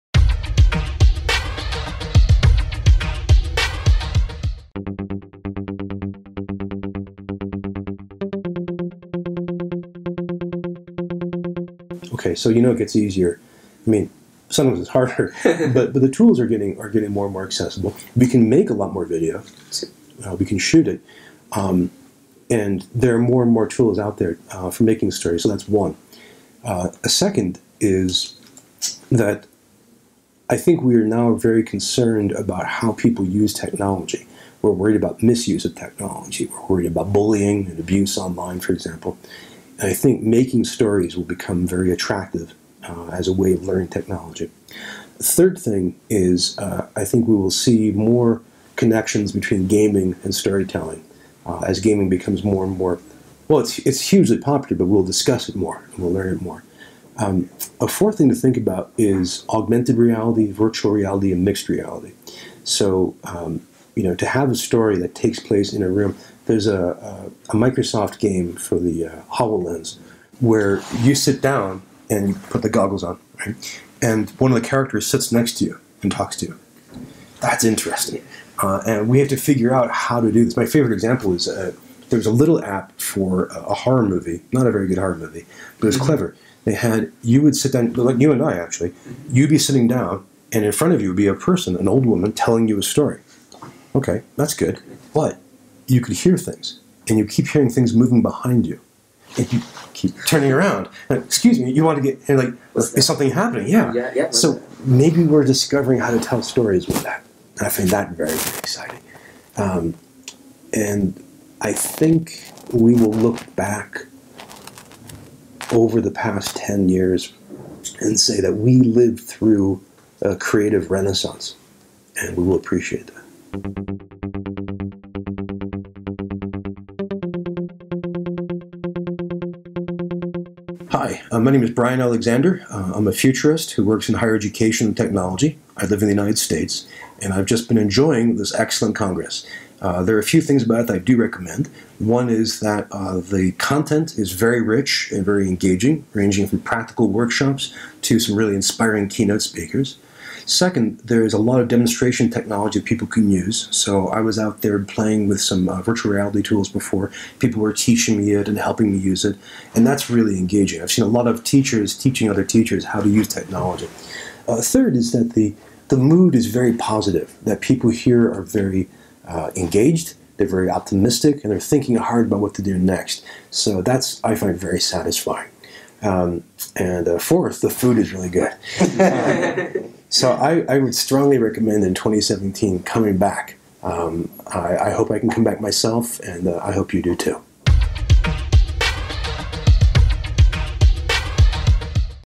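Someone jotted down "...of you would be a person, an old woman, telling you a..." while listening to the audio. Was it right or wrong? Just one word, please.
right.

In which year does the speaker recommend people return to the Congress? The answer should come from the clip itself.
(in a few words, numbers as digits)
2017.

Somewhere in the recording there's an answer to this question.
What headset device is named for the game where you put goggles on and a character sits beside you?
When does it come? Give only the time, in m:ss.
1:09.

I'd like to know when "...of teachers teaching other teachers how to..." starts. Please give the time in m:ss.
2:41.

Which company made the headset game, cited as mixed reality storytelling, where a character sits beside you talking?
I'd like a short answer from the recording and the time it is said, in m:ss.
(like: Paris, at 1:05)
Microsoft, at 1:07.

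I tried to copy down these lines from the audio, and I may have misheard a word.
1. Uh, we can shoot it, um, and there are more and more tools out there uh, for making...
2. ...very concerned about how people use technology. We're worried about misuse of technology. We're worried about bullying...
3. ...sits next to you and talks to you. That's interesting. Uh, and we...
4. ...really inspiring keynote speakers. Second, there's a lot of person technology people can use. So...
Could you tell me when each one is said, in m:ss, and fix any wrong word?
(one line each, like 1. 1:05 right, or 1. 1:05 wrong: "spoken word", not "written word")
1. 0:20 right
2. 0:31 right
3. 1:15 right
4. 2:28 wrong: "demonstration", not "person".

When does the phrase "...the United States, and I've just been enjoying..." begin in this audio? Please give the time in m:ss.
2:16.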